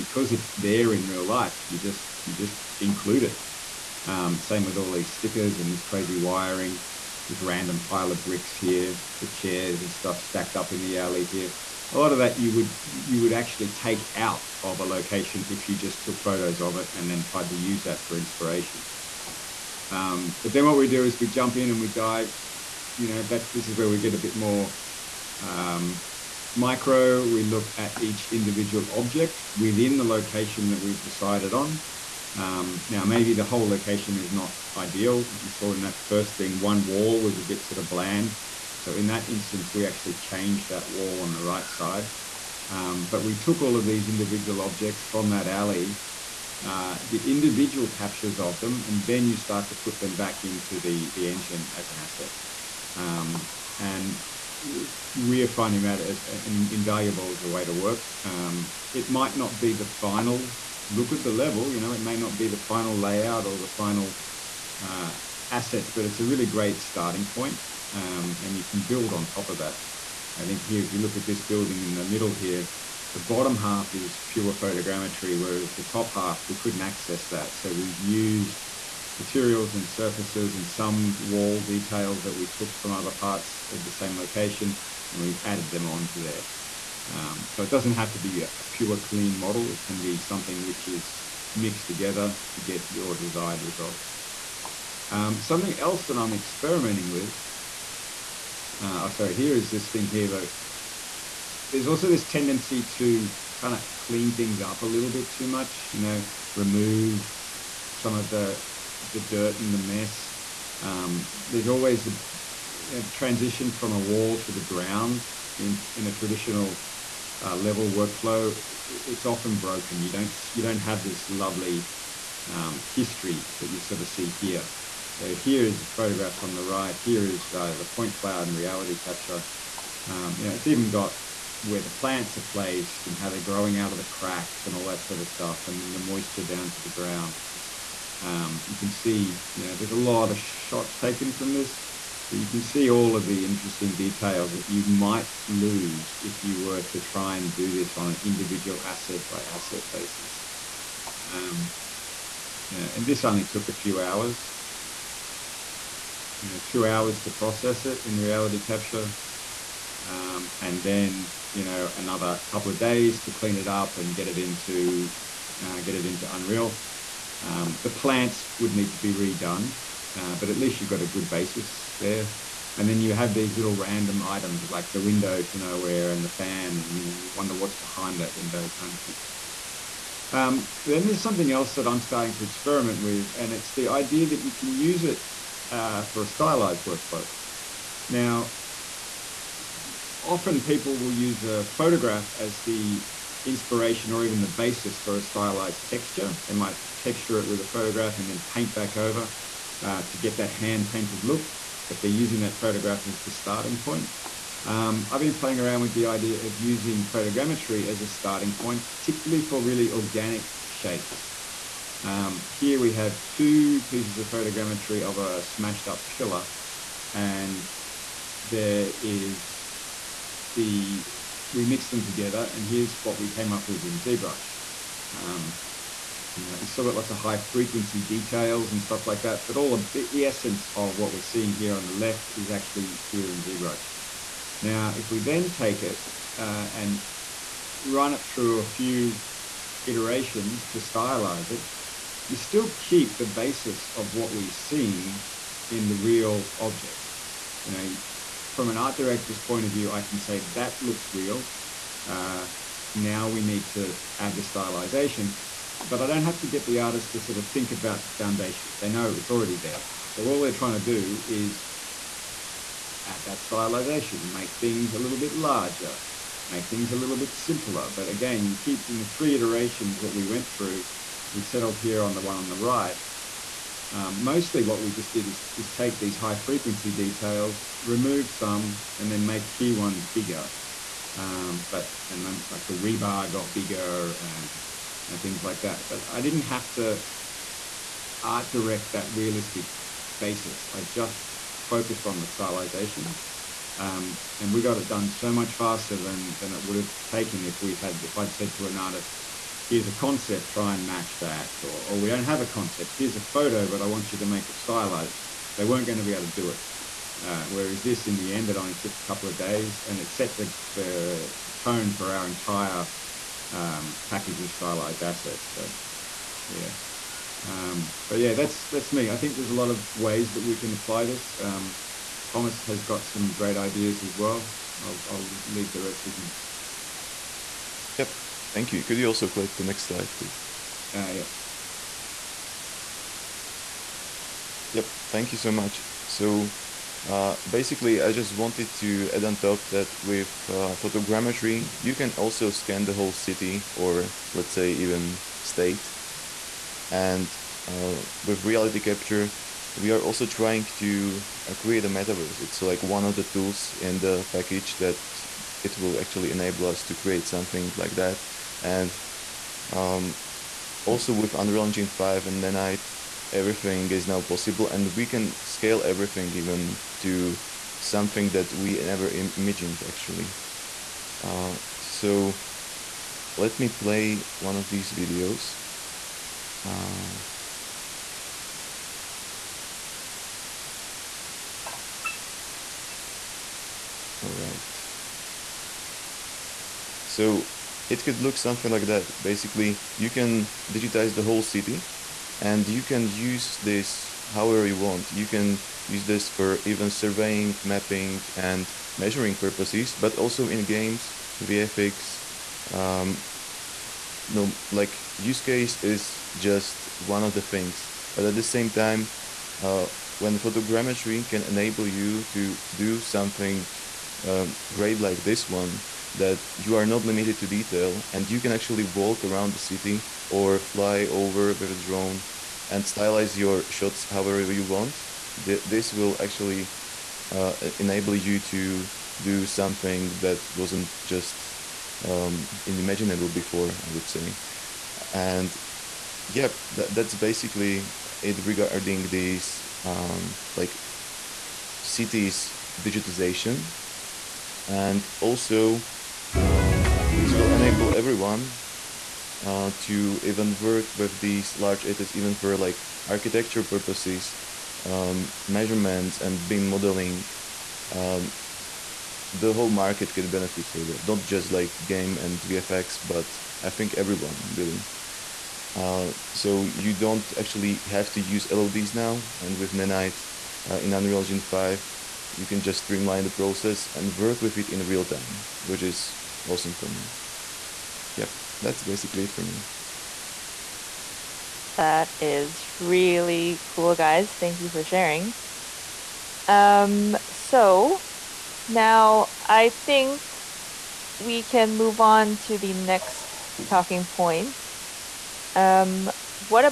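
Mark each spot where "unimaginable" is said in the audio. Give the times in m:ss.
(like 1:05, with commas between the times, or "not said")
7:12.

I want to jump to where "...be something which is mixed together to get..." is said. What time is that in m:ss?
1:30.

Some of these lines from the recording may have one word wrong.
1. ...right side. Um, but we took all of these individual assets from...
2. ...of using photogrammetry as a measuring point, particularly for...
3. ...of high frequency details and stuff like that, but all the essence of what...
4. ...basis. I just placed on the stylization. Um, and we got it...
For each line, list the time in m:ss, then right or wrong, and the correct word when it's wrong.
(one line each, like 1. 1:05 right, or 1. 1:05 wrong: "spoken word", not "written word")
1. 0:41 wrong: "objects", not "assets"
2. 3:26 wrong: "starting", not "measuring"
3. 3:47 right
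4. 4:50 wrong: "focused", not "placed".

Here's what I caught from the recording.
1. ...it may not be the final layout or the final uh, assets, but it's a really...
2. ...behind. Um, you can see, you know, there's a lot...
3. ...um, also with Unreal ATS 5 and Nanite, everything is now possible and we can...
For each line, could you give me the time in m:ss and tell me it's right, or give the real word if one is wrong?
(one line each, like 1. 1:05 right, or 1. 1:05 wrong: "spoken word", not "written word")
1. 1:01 right
2. 2:16 wrong: "ground", not "behind"
3. 5:59 wrong: "Engine", not "ATS".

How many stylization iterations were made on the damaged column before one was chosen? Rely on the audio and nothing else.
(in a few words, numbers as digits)
3.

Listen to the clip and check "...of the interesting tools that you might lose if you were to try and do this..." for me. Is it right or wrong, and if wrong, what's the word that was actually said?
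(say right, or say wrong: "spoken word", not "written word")
wrong: "details", not "tools".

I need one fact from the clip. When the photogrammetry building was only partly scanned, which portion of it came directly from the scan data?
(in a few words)
The bottom half.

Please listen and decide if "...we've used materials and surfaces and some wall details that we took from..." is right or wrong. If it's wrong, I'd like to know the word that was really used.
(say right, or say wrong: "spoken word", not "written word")
right.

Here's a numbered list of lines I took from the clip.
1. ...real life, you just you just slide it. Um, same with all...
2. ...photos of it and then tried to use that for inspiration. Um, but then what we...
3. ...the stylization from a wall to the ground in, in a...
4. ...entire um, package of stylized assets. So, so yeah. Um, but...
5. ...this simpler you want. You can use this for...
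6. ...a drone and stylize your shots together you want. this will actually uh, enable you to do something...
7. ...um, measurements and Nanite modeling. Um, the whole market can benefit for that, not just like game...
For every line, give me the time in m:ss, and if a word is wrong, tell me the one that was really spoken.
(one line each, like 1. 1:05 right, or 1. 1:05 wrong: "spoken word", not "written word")
1. 0:01 wrong: "include", not "slide"
2. 0:16 right
3. 1:53 wrong: "transition", not "stylization"
4. 5:12 right
5. 6:33 wrong: "however", not "simpler"
6. 7:01 wrong: "however", not "together"
7. 7:34 wrong: "BIM", not "Nanite".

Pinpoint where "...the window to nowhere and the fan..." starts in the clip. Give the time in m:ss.
2:54.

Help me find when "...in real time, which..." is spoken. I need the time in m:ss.
7:54.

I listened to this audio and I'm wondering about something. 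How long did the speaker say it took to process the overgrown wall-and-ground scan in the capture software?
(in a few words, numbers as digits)
2 hours.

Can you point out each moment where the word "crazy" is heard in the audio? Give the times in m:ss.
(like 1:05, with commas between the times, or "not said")
0:05.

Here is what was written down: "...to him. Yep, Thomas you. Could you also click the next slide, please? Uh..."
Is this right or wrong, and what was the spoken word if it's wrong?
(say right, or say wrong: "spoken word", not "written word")
wrong: "Thank", not "Thomas".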